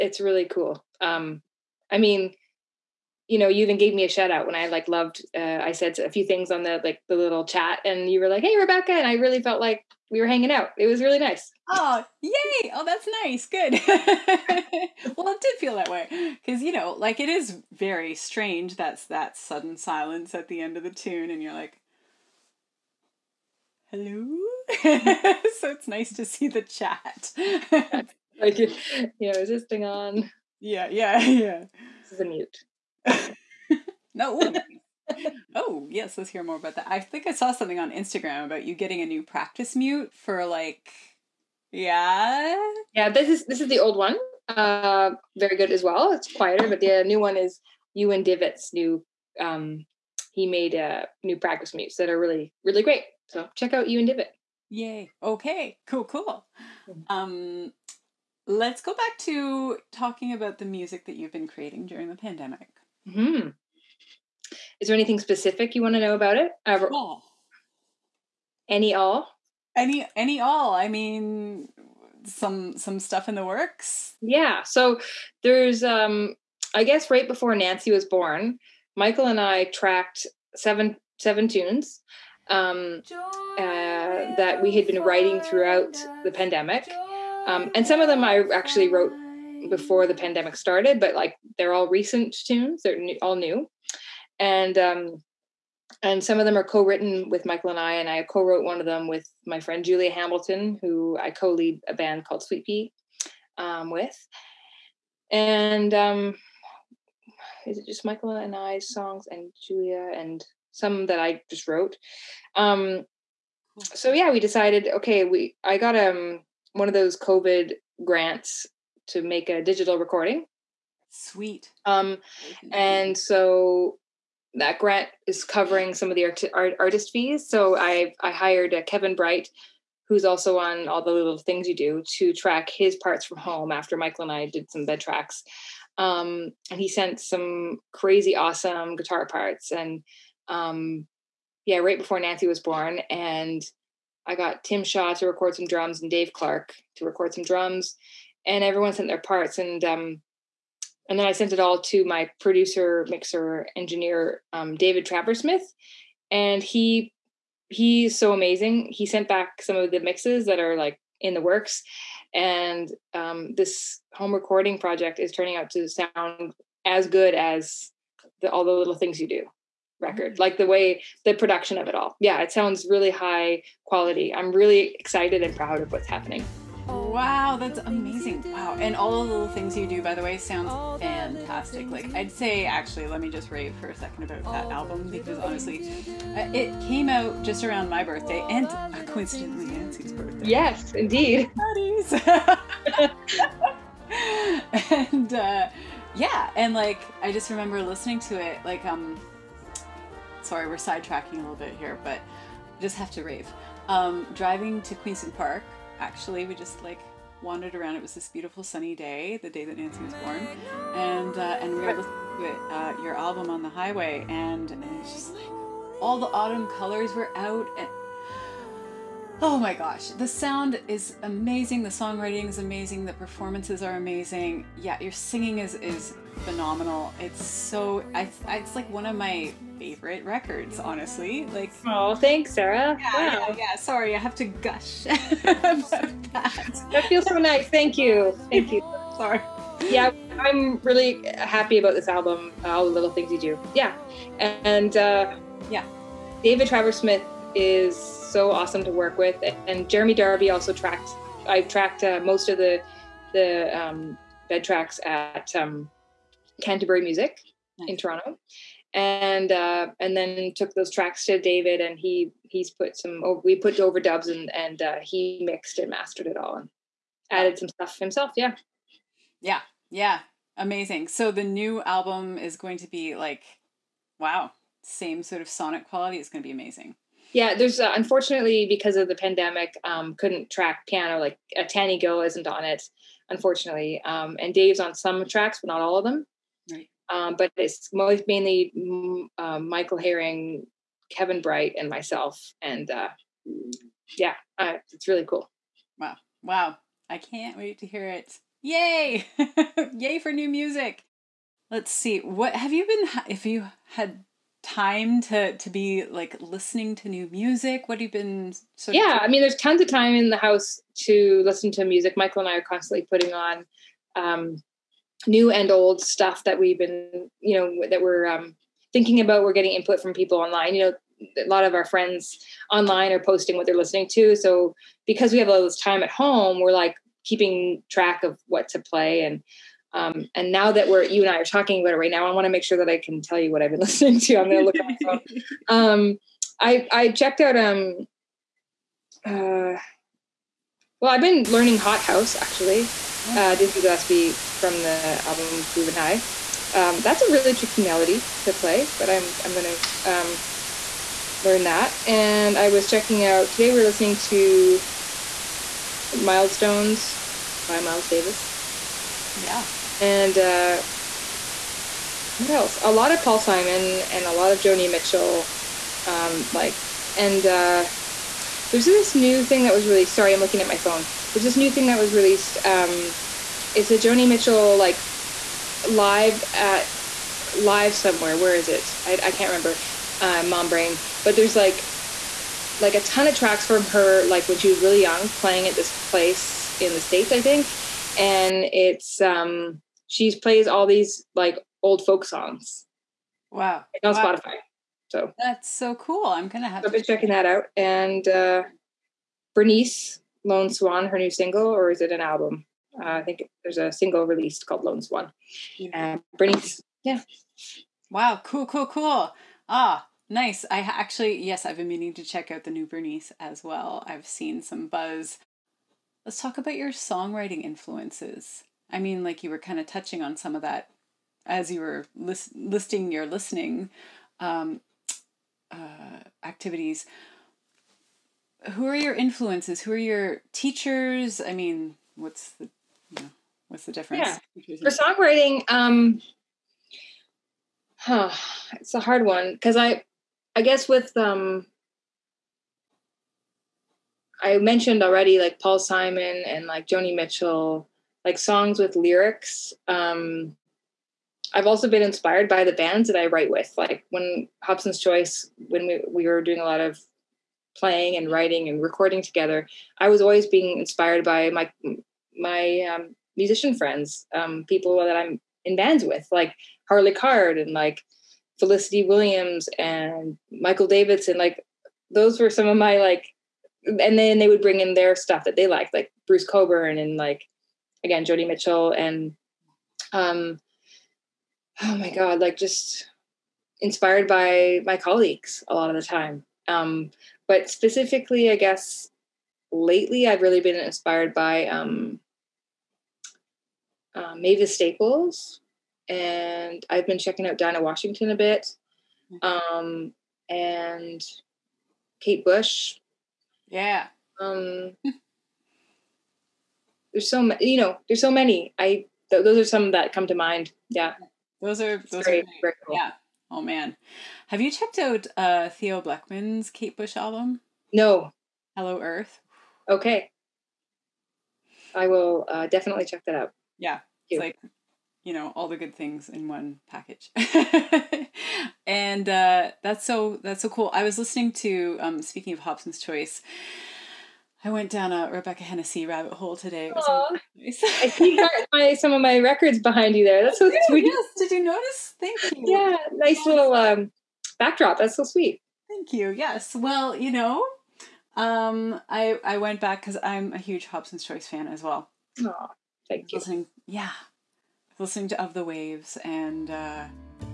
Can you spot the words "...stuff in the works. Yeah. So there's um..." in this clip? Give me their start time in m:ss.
1:12.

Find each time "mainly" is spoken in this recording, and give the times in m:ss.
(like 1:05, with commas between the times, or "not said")
4:48.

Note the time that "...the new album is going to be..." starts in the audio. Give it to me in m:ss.
4:31.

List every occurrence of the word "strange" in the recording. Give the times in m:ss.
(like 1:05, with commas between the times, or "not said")
0:18.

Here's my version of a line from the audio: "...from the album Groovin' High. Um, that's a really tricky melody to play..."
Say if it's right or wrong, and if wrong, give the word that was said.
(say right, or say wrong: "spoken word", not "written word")
right.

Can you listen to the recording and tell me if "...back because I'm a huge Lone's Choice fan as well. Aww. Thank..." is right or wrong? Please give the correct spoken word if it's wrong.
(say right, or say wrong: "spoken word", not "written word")
wrong: "Hobson", not "Lone".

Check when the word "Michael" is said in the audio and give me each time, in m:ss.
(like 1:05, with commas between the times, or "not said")
1:18, 1:37, 1:48, 2:13, 4:49, 5:12, 7:50.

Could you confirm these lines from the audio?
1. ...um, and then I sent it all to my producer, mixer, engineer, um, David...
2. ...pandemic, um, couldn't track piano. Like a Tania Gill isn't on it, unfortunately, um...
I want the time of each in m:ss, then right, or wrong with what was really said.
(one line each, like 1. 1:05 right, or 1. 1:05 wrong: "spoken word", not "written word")
1. 2:29 right
2. 4:39 right.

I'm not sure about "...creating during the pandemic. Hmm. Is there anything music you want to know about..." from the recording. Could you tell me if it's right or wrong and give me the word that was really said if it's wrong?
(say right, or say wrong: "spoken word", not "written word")
wrong: "specific", not "music".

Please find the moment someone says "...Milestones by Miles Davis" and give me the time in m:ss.
5:56.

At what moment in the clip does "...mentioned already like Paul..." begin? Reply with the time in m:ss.
7:24.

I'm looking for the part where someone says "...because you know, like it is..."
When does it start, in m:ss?
0:16.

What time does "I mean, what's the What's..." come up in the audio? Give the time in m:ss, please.
7:11.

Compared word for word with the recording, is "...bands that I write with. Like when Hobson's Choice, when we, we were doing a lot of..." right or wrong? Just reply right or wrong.
right.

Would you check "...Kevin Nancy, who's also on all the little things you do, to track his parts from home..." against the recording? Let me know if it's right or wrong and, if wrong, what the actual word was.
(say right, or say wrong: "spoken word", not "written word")
wrong: "Bright", not "Nancy".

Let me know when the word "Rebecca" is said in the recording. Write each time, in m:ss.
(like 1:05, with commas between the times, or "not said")
0:08, 8:55.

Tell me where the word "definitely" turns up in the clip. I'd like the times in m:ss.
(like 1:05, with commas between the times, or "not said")
8:42.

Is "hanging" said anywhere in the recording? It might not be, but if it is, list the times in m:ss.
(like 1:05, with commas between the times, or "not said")
0:10.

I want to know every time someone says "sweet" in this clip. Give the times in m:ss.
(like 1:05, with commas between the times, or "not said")
1:42, 2:01, 9:00, 9:05.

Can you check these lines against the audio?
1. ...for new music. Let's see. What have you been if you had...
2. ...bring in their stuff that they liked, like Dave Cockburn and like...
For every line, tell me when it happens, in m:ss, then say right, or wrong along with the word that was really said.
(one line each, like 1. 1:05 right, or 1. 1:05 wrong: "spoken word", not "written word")
1. 5:00 right
2. 7:54 wrong: "Bruce", not "Dave".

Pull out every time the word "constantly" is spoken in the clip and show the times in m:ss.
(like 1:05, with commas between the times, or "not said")
5:12.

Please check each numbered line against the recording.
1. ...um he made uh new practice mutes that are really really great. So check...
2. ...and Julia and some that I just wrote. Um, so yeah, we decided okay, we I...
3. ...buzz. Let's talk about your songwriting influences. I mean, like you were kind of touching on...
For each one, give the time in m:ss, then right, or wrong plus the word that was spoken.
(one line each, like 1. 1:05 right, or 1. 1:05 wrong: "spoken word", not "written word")
1. 0:49 right
2. 1:49 right
3. 6:54 right.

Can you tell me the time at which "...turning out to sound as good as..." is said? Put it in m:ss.
2:45.